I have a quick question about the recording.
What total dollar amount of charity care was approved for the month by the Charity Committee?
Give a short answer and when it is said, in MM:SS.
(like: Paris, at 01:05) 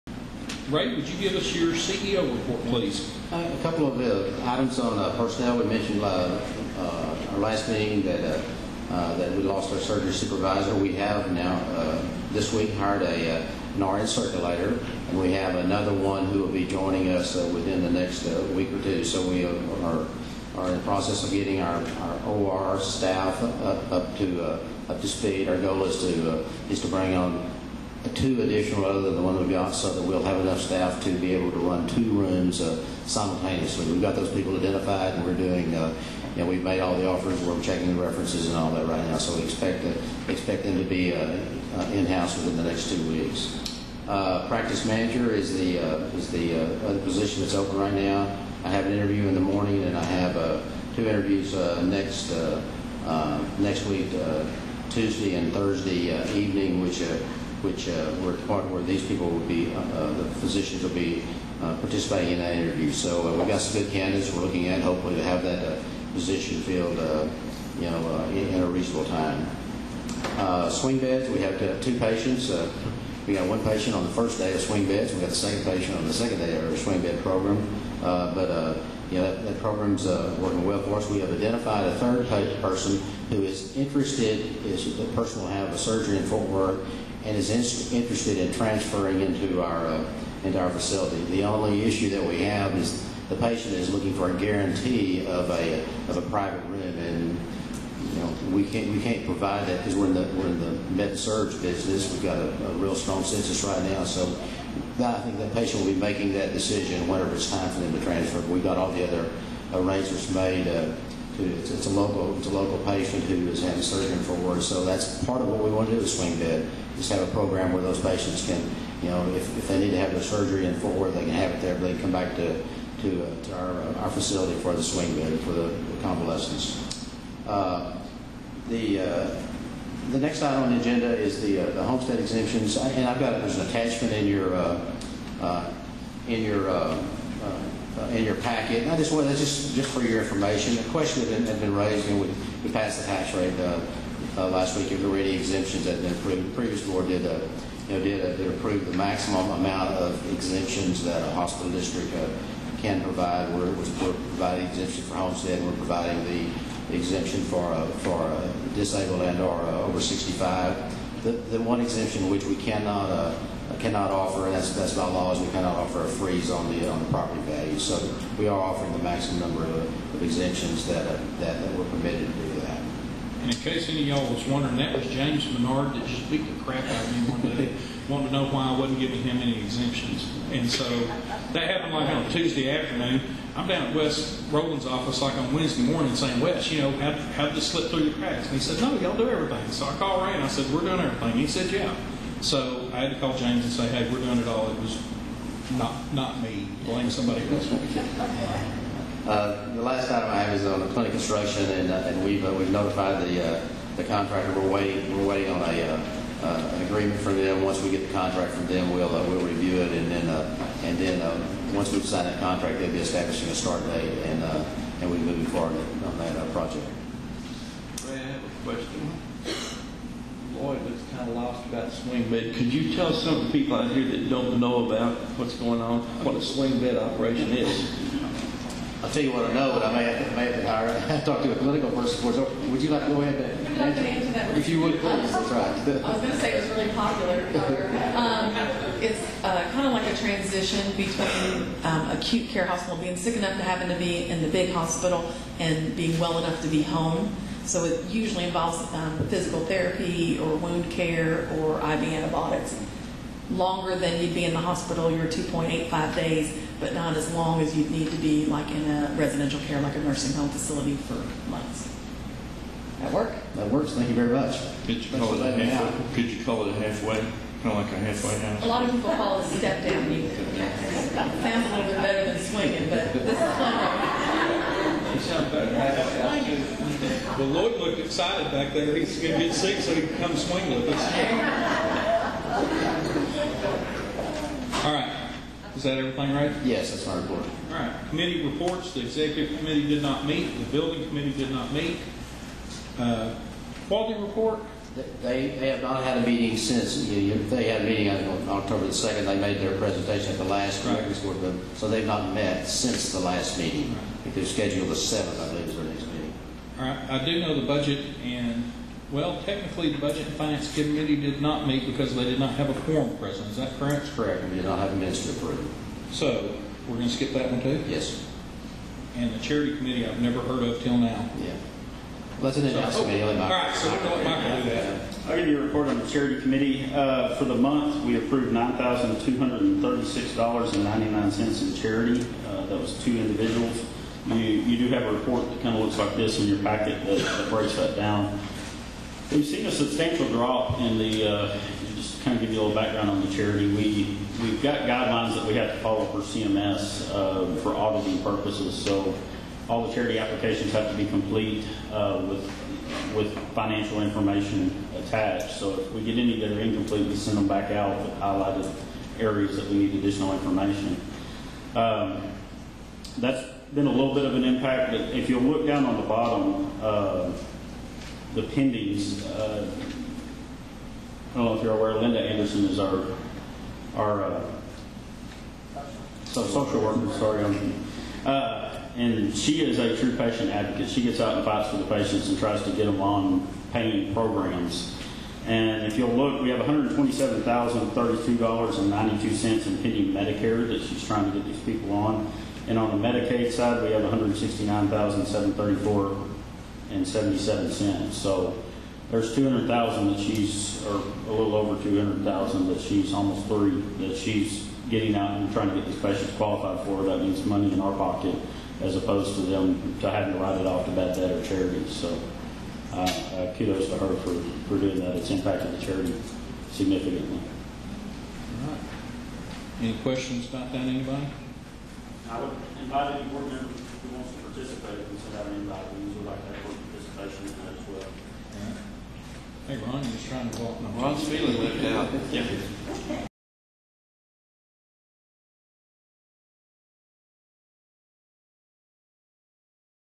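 $9,236.99, at 05:28.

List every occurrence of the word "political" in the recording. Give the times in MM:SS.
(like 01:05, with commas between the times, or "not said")
03:51.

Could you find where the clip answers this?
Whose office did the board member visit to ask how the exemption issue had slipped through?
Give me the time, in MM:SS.
03:03.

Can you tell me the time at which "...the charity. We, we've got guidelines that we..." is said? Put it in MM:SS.
05:43.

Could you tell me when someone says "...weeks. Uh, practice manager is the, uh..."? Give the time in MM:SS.
00:43.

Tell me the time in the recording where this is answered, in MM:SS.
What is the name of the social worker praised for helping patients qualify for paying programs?
06:11.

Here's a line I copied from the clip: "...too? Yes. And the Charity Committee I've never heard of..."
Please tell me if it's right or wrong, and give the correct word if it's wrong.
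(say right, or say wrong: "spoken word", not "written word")
right.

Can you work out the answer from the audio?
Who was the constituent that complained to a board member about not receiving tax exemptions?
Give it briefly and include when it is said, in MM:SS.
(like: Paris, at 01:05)
James Menard, at 02:55.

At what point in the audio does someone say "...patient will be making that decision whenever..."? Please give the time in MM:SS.
01:45.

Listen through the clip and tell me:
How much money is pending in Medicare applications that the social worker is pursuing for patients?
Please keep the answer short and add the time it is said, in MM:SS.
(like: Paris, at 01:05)
$127,032.92, at 06:26.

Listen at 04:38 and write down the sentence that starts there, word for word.
He's going to get sick so he can come swing with us.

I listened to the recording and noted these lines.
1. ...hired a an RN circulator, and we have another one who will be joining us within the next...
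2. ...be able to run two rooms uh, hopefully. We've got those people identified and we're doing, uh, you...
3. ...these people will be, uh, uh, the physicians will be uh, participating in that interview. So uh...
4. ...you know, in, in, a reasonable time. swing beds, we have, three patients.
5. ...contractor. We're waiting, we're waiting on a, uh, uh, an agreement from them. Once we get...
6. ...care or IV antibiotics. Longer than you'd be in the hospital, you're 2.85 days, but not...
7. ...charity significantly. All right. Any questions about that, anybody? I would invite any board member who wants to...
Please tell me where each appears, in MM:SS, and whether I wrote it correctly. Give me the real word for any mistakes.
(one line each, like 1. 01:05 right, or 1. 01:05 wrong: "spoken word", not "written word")
1. 00:12 right
2. 00:31 wrong: "simultaneously", not "hopefully"
3. 00:58 right
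4. 01:07 wrong: "two", not "three"
5. 03:24 right
6. 04:10 right
7. 06:55 right.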